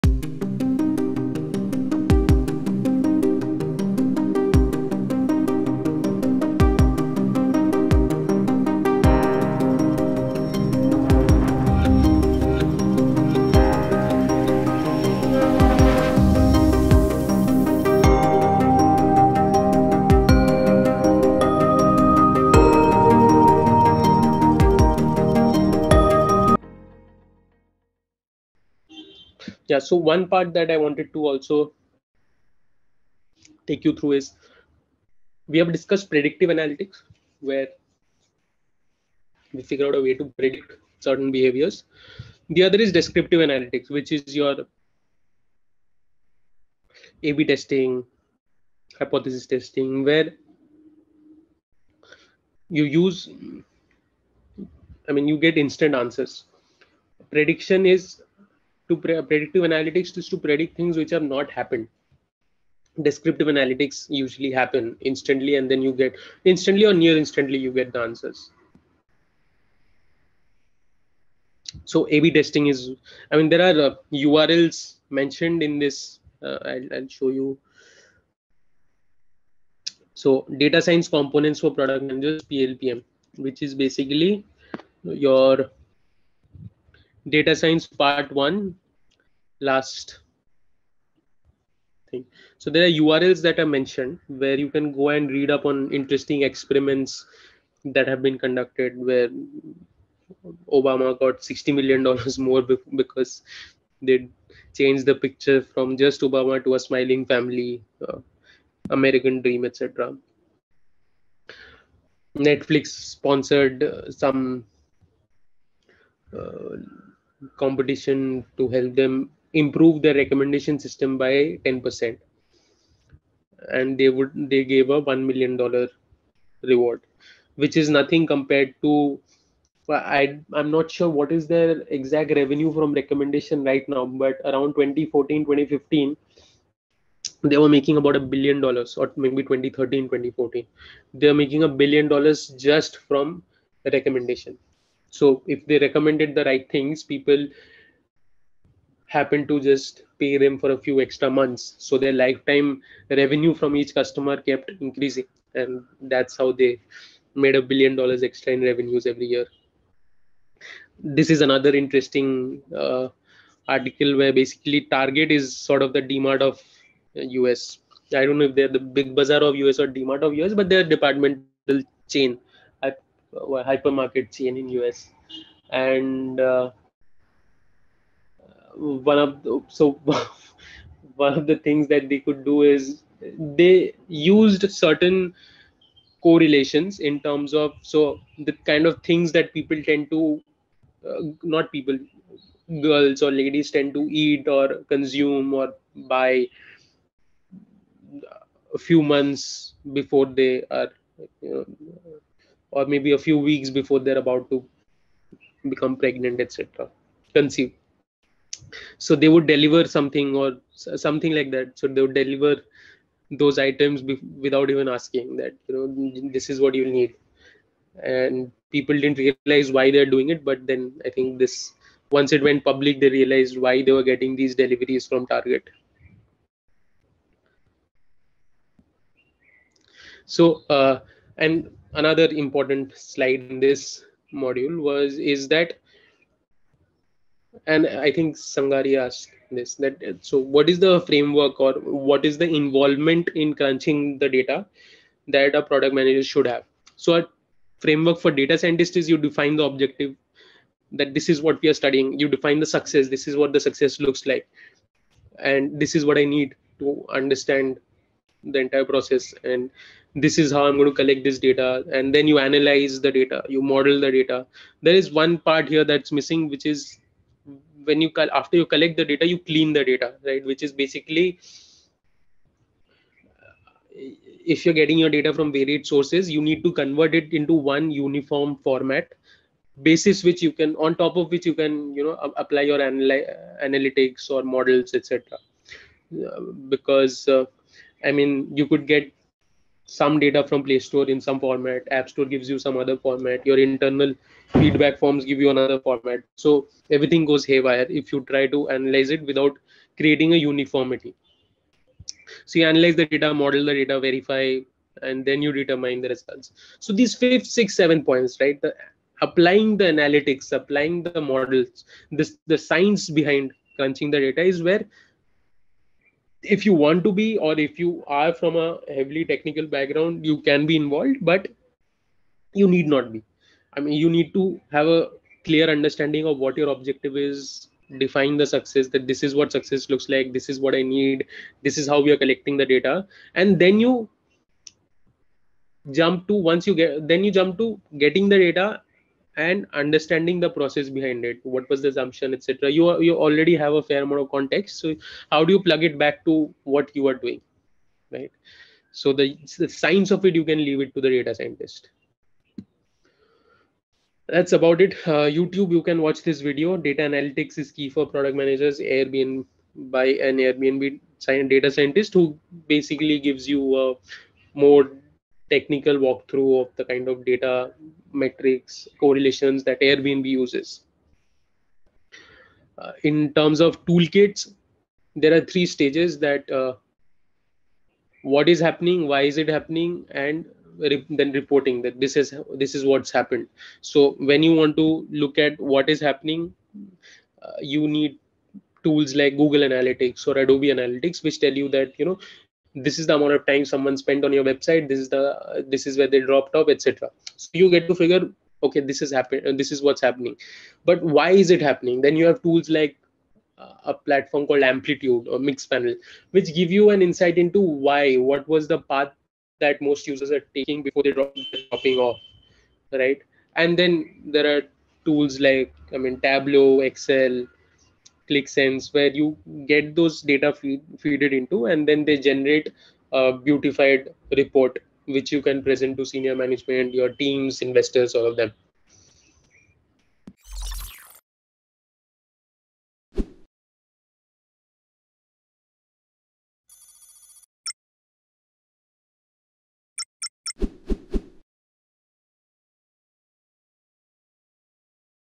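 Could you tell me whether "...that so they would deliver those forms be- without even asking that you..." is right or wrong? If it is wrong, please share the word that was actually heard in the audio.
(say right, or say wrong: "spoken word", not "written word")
wrong: "items", not "forms".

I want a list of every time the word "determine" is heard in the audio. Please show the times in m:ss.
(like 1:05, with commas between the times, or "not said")
5:05.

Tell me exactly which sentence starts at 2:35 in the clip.
And that's how they made a billion dollars extra in revenues every year.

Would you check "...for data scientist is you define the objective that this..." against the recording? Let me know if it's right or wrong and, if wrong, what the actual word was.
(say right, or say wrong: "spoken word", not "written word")
right.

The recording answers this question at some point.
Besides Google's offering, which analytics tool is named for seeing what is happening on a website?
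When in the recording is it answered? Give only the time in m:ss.
6:30.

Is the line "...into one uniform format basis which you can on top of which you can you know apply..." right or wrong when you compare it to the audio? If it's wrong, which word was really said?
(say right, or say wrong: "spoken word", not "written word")
right.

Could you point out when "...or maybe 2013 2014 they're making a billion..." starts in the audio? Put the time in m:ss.
2:18.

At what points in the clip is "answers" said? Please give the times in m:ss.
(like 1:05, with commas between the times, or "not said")
0:56, 1:08.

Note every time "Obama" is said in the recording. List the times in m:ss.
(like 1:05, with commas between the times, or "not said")
1:40, 1:46.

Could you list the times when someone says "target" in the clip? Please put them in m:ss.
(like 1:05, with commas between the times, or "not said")
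2:44, 3:45.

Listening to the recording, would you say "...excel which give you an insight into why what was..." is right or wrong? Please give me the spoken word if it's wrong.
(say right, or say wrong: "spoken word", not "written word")
wrong: "mixpanel", not "excel".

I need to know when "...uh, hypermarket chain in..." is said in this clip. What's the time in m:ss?
2:52.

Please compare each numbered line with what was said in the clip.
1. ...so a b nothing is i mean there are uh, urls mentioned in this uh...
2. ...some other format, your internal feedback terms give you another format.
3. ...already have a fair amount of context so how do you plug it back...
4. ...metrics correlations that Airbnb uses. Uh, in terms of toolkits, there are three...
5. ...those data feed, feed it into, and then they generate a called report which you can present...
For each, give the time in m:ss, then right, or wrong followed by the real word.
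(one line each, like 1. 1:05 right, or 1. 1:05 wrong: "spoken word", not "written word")
1. 1:11 wrong: "testing", not "nothing"
2. 4:52 wrong: "forms", not "terms"
3. 5:43 right
4. 6:08 right
5. 6:59 wrong: "beautified", not "called".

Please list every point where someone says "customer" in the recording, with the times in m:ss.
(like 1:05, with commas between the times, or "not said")
2:33.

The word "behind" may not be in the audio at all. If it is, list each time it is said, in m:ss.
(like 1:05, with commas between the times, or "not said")
5:13, 5:40.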